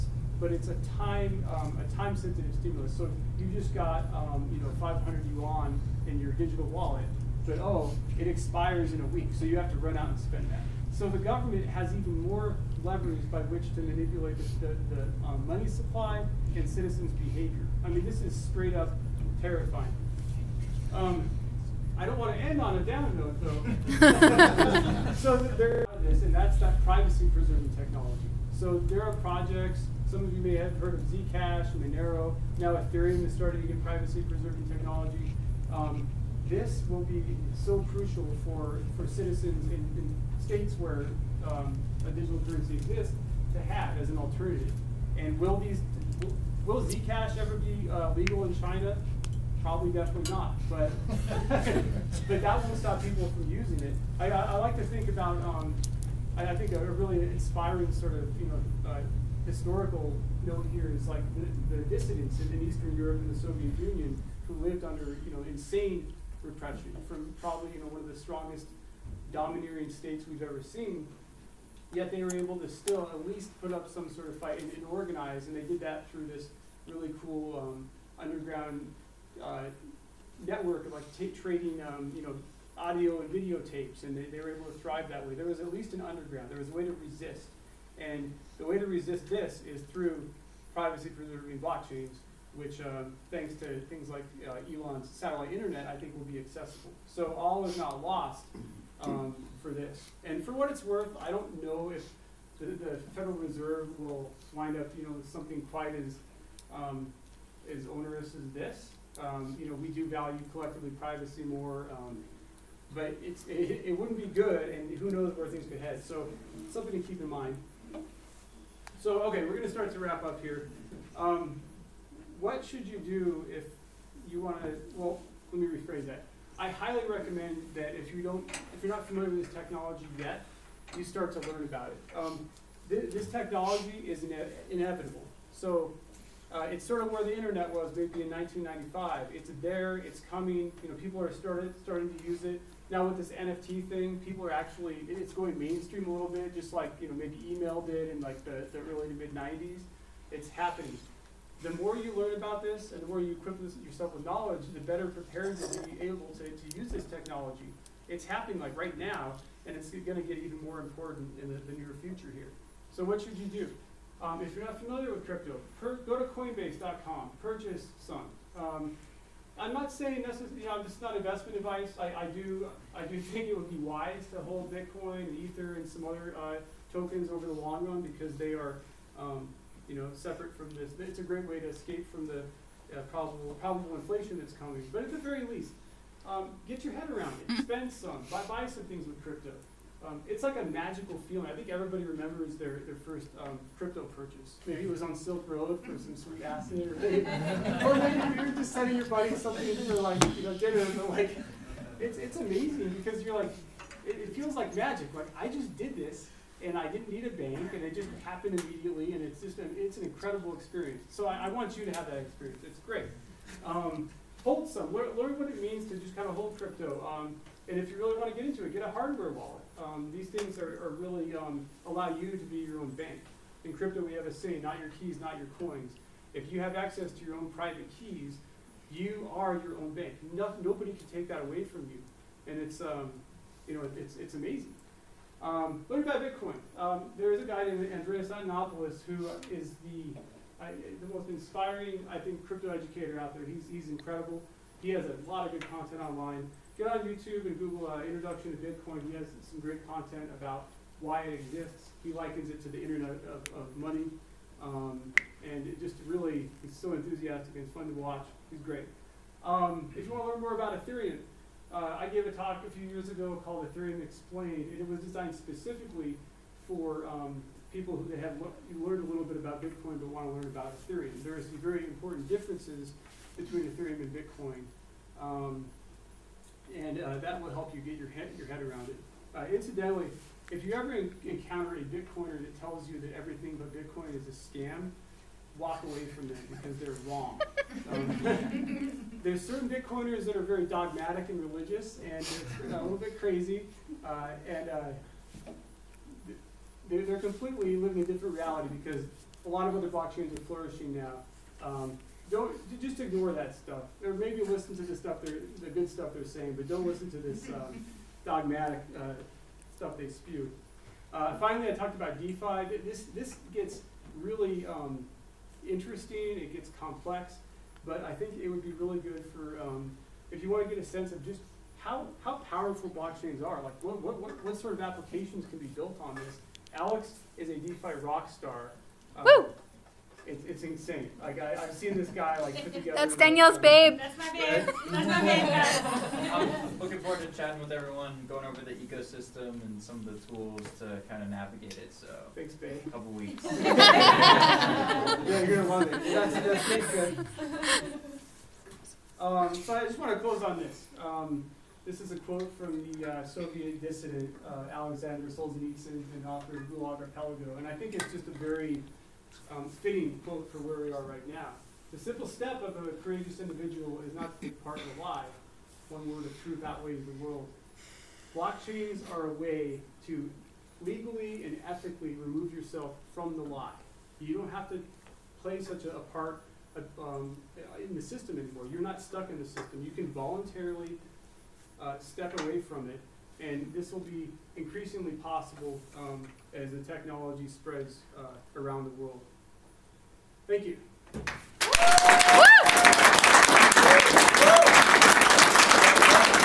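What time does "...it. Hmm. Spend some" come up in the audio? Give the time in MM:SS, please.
03:07.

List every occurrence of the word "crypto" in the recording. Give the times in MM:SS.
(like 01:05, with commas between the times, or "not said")
02:45, 03:09, 03:13, 03:36, 03:43, 04:02.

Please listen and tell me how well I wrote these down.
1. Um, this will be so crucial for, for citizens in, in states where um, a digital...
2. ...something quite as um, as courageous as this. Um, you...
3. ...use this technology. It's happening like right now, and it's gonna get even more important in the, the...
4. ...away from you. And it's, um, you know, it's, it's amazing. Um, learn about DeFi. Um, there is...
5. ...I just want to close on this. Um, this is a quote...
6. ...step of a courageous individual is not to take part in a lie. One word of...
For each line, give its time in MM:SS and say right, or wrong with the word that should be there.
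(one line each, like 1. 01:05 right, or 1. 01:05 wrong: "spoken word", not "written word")
1. 00:35 right
2. 01:45 wrong: "onerous", not "courageous"
3. 02:36 right
4. 03:51 wrong: "Bitcoin", not "DeFi"
5. 05:49 right
6. 06:02 right.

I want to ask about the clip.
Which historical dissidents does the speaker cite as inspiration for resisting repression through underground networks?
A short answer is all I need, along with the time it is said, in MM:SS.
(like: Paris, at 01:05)
Eastern Europe and the Soviet Union, at 01:02.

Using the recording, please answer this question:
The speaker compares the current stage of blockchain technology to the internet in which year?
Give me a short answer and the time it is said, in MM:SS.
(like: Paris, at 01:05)
1995, at 02:18.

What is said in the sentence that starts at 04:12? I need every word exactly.
He likens it to the Internet of, of money.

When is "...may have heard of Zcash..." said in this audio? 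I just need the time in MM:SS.
00:30.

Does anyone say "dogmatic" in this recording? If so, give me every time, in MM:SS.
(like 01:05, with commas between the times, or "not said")
04:50, 05:08.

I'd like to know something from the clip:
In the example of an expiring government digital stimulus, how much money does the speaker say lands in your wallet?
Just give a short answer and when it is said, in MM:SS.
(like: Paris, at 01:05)
500 yuan, at 00:04.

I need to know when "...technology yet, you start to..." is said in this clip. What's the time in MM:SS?
02:09.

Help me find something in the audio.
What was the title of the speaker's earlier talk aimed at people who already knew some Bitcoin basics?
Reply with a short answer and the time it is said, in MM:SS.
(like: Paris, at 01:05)
Ethereum Explained, at 04:23.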